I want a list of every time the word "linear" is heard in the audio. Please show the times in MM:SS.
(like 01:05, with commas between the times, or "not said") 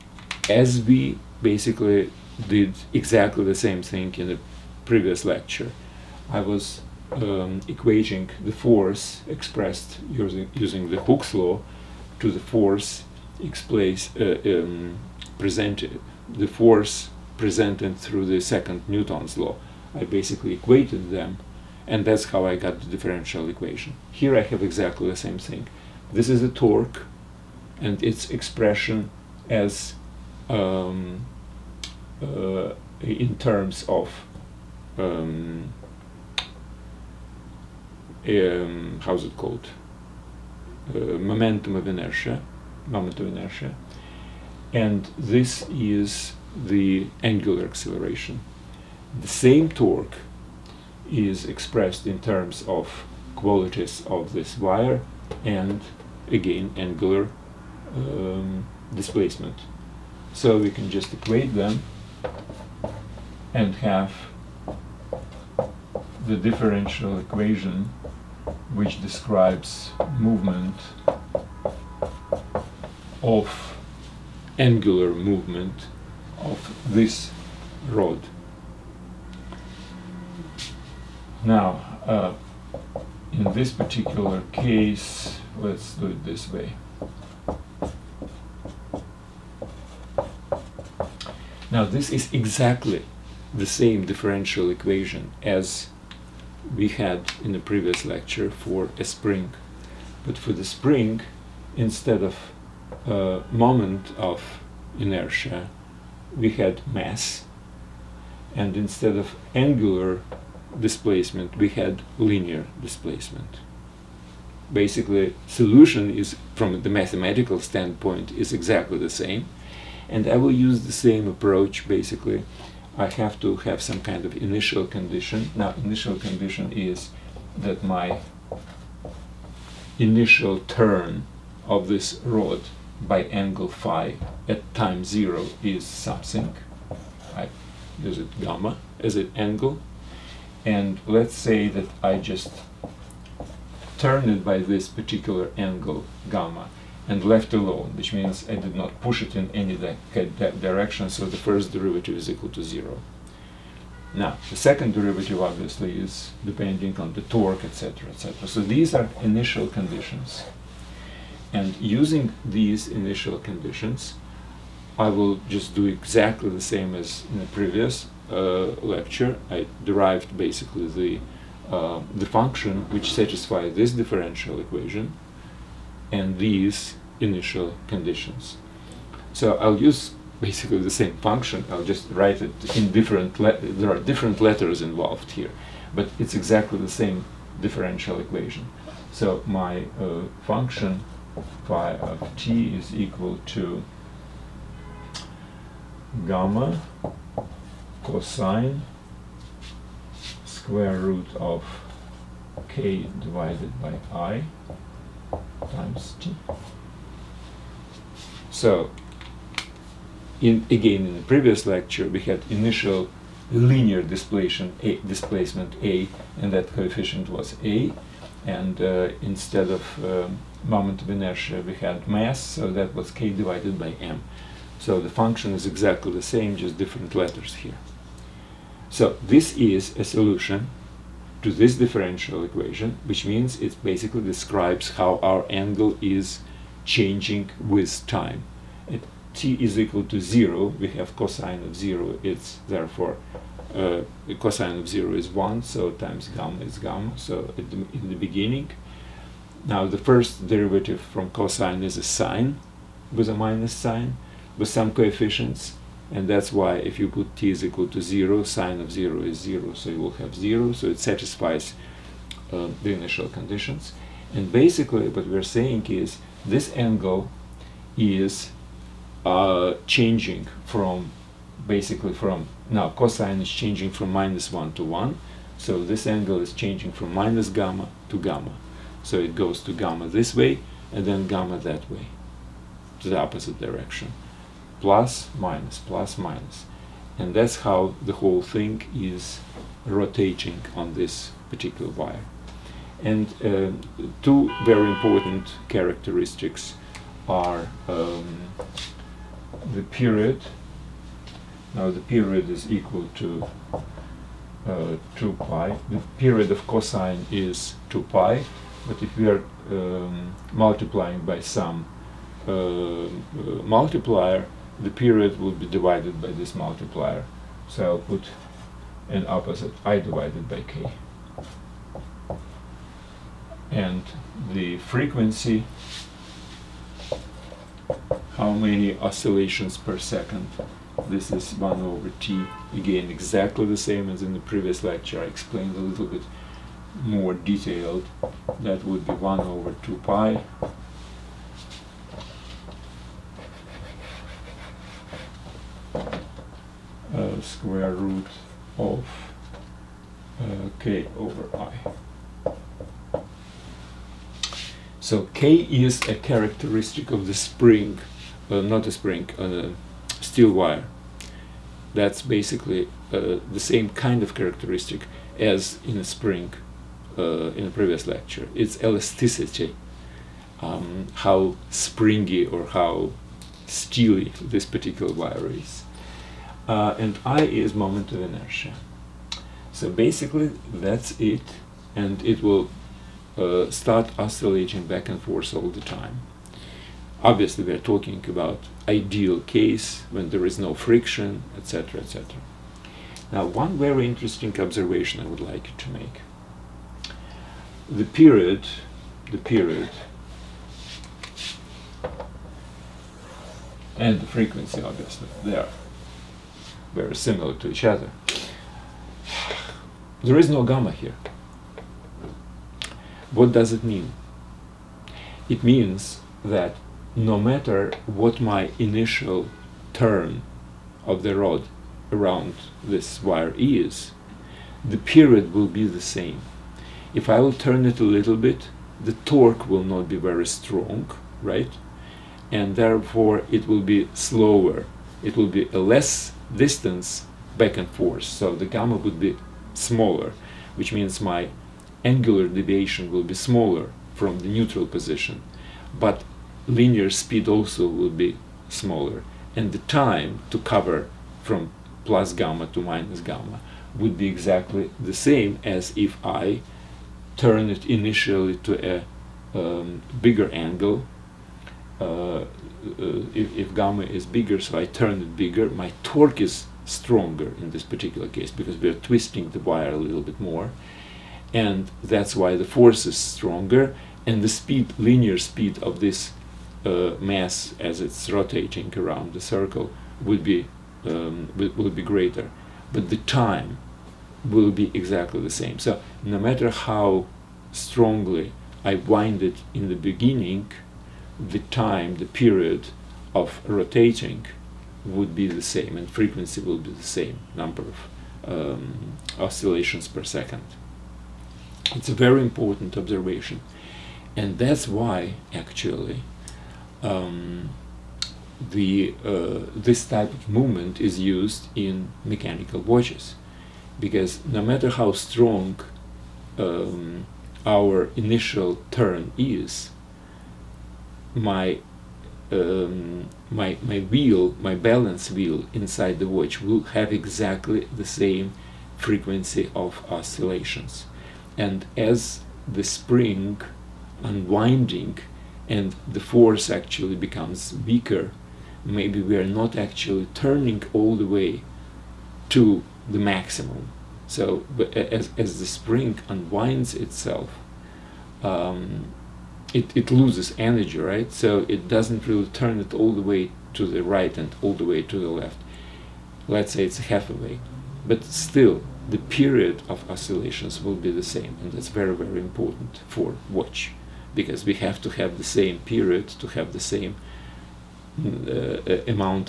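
01:52, 03:33, 07:26, 07:54.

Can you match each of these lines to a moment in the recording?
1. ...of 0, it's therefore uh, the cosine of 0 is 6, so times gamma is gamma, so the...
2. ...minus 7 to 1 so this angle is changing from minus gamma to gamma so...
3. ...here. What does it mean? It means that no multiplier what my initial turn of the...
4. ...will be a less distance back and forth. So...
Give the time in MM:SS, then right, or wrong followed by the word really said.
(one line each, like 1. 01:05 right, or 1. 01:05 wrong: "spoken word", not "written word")
1. 04:01 wrong: "1", not "6"
2. 04:34 wrong: "1", not "7"
3. 06:50 wrong: "matter", not "multiplier"
4. 07:15 right.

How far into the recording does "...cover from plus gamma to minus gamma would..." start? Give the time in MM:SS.
07:30.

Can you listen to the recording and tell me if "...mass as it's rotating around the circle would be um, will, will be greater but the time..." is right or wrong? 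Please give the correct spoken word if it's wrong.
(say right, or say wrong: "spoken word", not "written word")
right.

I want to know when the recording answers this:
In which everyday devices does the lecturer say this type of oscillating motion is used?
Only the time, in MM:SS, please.
08:32.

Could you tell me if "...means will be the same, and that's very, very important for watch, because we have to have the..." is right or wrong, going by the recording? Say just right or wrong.
wrong.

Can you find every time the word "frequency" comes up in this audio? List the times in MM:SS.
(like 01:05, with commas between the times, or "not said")
05:24, 06:44, 08:16, 08:48.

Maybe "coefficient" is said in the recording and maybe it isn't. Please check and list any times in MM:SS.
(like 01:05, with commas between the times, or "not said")
03:36, 04:14.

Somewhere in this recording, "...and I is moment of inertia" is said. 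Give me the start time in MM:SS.
06:16.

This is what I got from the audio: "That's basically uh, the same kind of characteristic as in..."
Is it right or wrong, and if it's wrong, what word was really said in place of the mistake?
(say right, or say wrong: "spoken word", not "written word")
right.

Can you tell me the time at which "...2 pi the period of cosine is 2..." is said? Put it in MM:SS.
05:05.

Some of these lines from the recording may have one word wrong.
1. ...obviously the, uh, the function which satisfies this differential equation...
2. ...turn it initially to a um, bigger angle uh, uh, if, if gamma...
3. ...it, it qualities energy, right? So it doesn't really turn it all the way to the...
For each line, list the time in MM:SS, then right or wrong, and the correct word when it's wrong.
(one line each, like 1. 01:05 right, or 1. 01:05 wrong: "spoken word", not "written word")
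1. 02:50 wrong: "basically", not "obviously"
2. 07:37 right
3. 09:09 wrong: "loses", not "qualities".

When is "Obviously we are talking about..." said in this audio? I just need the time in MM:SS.
06:27.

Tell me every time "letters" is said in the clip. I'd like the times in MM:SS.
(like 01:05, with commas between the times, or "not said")
03:04, 03:47.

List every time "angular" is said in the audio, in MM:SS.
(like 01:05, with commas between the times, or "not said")
00:47, 00:56, 01:14, 01:49, 07:22.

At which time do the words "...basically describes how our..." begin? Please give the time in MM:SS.
03:53.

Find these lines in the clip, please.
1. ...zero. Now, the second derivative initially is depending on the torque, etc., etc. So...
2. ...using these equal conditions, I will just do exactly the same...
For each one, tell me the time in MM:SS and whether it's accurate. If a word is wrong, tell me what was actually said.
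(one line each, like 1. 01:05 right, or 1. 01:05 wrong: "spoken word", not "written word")
1. 02:32 wrong: "obviously", not "initially"
2. 02:41 wrong: "initial", not "equal".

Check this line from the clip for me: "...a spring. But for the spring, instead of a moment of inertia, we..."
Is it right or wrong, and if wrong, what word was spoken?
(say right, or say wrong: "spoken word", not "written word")
right.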